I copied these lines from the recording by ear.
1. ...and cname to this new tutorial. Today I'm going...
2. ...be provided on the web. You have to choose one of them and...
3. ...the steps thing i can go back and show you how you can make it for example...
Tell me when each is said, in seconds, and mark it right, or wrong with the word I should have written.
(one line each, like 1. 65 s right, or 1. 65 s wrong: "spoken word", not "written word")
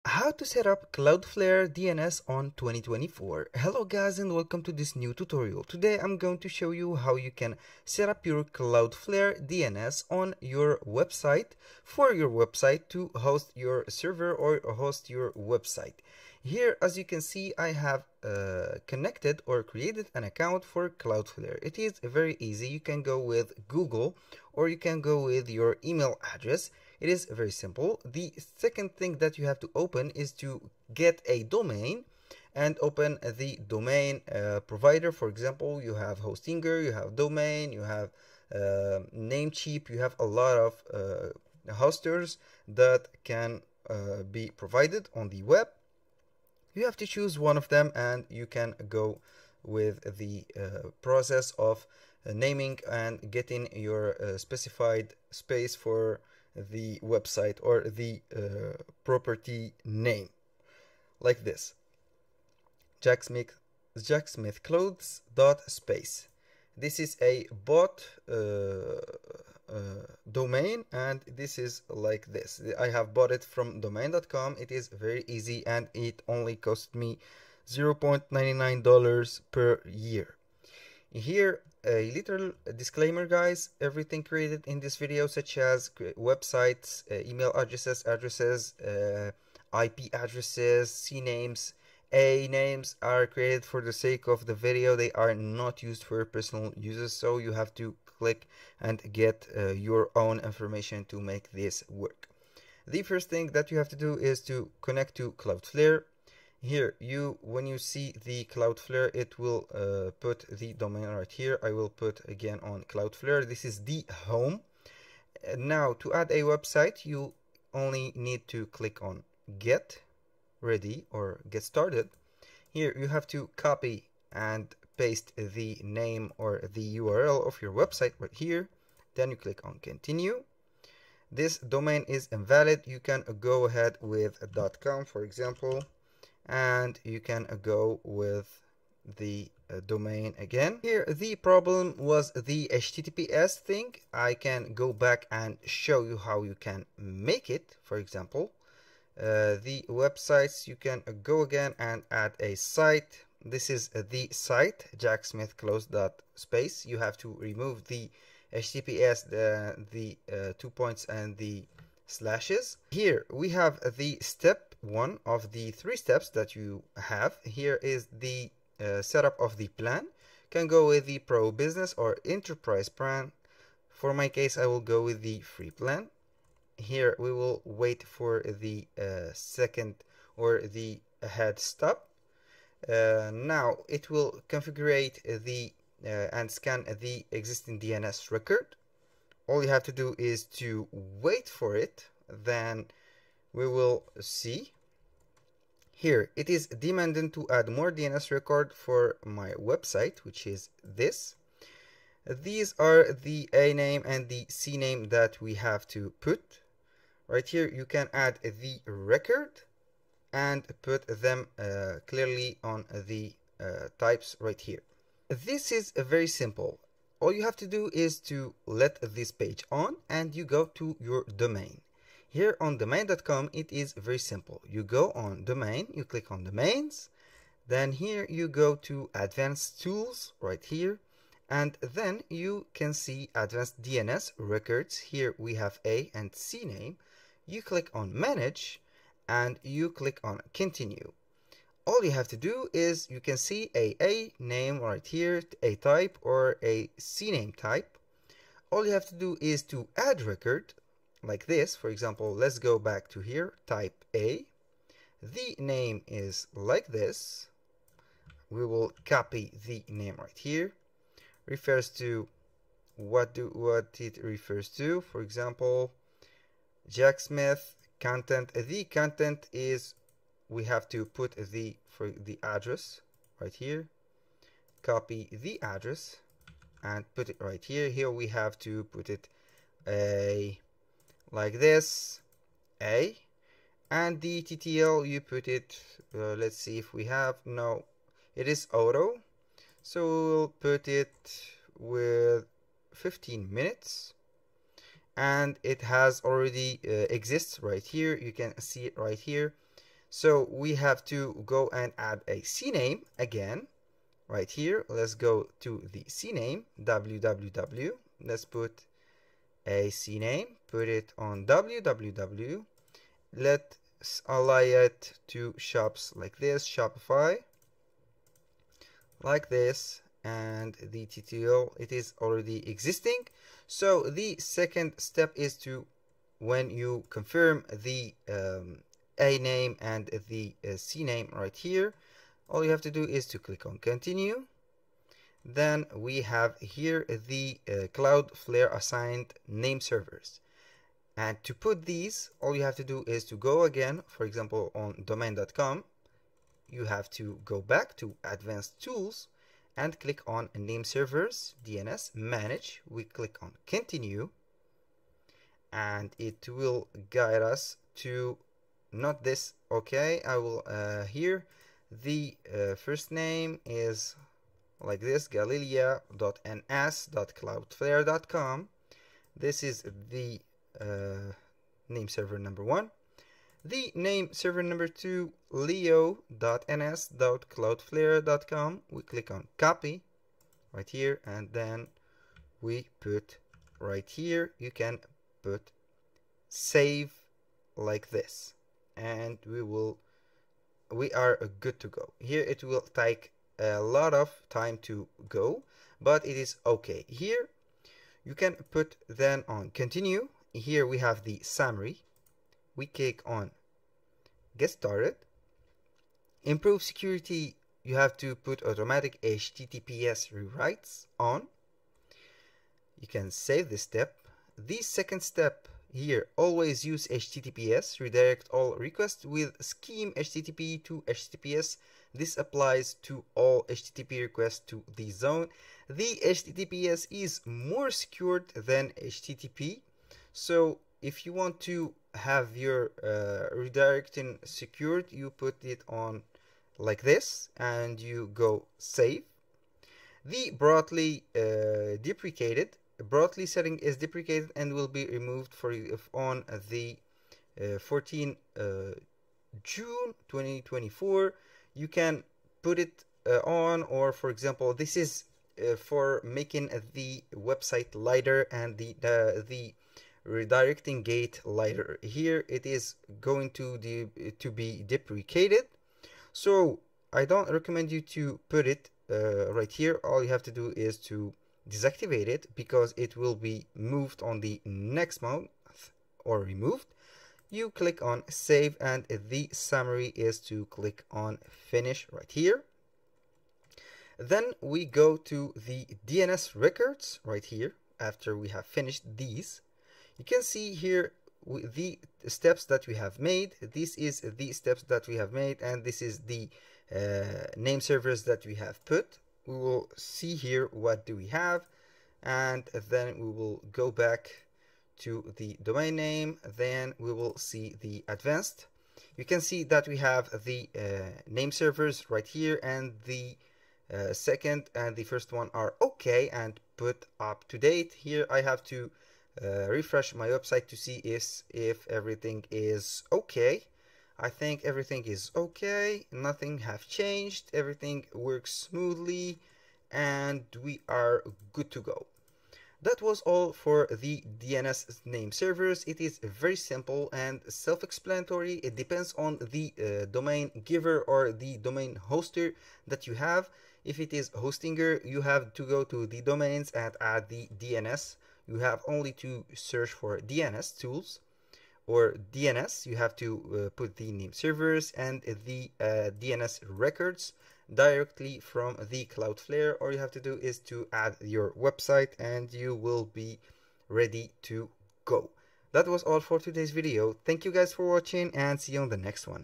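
1. 4 s wrong: "welcome", not "cname"
2. 44 s right
3. 142 s wrong: "https", not "steps".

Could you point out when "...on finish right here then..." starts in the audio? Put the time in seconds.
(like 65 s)
481 s.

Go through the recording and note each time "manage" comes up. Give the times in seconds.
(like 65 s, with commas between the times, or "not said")
238 s, 352 s.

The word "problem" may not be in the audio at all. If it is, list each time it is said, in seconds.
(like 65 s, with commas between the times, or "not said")
141 s.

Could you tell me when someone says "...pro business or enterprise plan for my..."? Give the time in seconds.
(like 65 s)
171 s.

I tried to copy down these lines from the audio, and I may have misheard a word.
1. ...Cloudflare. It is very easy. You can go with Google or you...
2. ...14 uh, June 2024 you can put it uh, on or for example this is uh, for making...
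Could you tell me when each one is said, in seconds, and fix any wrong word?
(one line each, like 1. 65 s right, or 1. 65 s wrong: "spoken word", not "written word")
1. 20 s right
2. 447 s right.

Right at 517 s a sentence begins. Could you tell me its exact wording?
Here I have to uh, refresh my website to see is if everything is okay.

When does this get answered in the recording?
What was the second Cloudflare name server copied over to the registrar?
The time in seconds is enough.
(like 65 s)
375 s.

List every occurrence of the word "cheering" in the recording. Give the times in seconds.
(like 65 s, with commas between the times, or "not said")
not said.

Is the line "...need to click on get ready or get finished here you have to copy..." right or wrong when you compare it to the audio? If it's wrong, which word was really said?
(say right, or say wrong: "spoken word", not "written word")
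wrong: "started", not "finished".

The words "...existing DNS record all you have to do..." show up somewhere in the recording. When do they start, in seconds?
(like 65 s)
187 s.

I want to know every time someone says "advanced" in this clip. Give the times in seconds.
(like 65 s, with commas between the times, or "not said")
229 s, 233 s, 348 s, 508 s.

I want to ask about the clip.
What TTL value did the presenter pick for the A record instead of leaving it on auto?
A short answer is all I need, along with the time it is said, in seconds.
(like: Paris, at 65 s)
15 minutes, at 292 s.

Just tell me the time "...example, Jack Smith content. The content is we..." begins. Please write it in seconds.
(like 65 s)
265 s.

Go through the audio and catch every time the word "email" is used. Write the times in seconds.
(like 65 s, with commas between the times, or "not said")
25 s, 87 s.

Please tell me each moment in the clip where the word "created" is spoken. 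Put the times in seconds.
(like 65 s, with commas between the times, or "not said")
19 s, 84 s, 93 s.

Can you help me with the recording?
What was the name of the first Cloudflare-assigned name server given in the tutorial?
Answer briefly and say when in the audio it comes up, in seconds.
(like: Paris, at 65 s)
galilea.ns.cloudflare.com, at 365 s.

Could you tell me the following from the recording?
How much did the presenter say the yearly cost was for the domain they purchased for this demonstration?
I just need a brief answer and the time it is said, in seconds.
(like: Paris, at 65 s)
$0.99, at 77 s.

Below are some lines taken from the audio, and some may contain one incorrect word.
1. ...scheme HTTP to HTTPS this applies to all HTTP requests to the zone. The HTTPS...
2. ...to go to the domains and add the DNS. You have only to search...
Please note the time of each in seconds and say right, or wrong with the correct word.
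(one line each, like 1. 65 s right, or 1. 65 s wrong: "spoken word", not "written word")
1. 419 s right
2. 545 s right.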